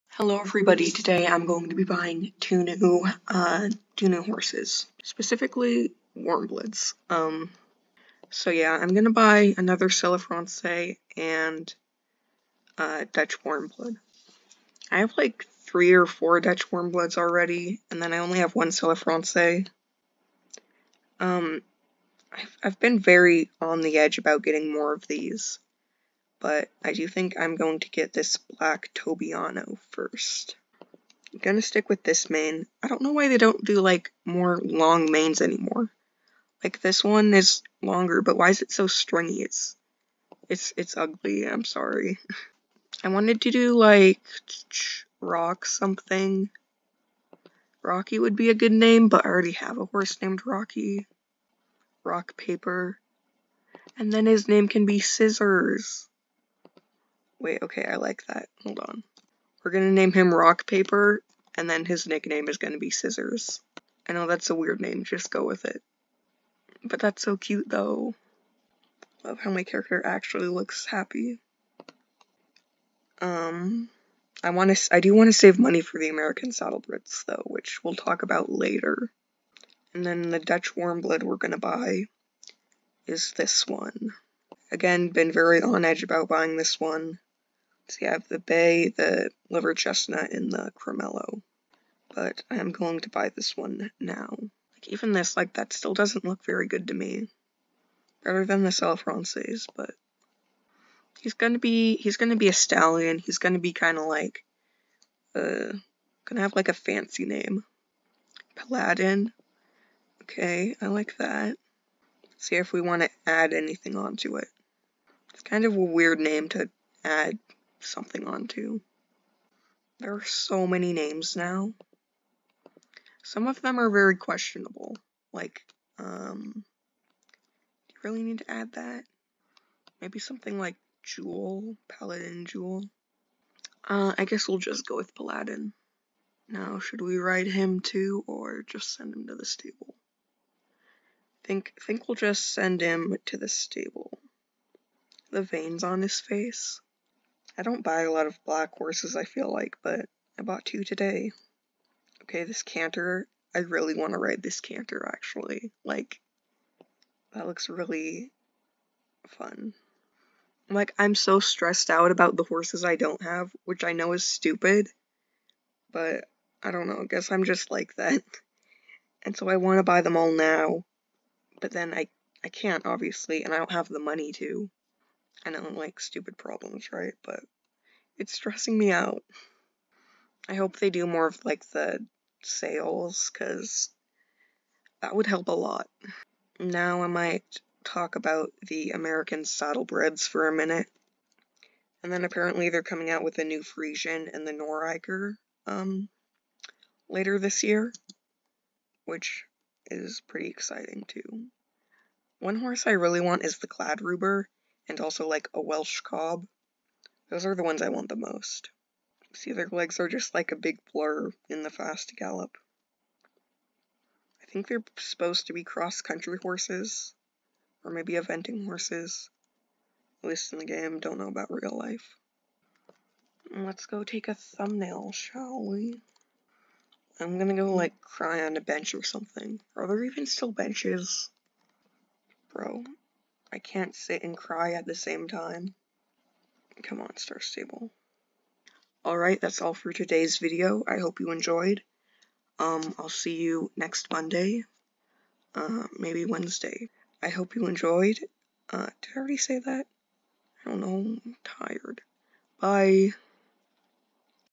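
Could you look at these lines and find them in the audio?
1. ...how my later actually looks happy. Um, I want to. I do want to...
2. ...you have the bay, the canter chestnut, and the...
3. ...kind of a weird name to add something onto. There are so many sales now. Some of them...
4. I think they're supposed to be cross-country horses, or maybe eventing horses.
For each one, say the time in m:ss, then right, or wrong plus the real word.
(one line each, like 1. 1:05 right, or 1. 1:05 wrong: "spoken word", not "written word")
1. 1:09 wrong: "character", not "later"
2. 1:28 wrong: "liver", not "canter"
3. 1:55 wrong: "names", not "sales"
4. 3:34 right.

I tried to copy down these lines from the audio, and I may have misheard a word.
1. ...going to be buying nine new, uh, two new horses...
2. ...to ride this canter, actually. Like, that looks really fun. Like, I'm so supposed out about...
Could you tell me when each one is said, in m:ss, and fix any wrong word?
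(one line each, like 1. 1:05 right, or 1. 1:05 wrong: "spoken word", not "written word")
1. 0:01 wrong: "two", not "nine"
2. 2:34 wrong: "stressed", not "supposed".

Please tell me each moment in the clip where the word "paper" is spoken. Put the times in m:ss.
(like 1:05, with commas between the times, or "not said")
0:52, 1:00.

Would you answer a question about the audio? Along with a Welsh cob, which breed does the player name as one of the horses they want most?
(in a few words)
Kladruber.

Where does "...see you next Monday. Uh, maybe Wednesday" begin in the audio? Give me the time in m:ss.
4:03.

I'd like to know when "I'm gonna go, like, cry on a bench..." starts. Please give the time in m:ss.
3:47.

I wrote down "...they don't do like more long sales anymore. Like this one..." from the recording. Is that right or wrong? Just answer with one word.
wrong.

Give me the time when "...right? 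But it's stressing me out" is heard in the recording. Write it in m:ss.
2:56.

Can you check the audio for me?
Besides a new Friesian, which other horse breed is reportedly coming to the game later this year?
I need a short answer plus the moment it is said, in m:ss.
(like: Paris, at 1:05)
Noriker, at 3:14.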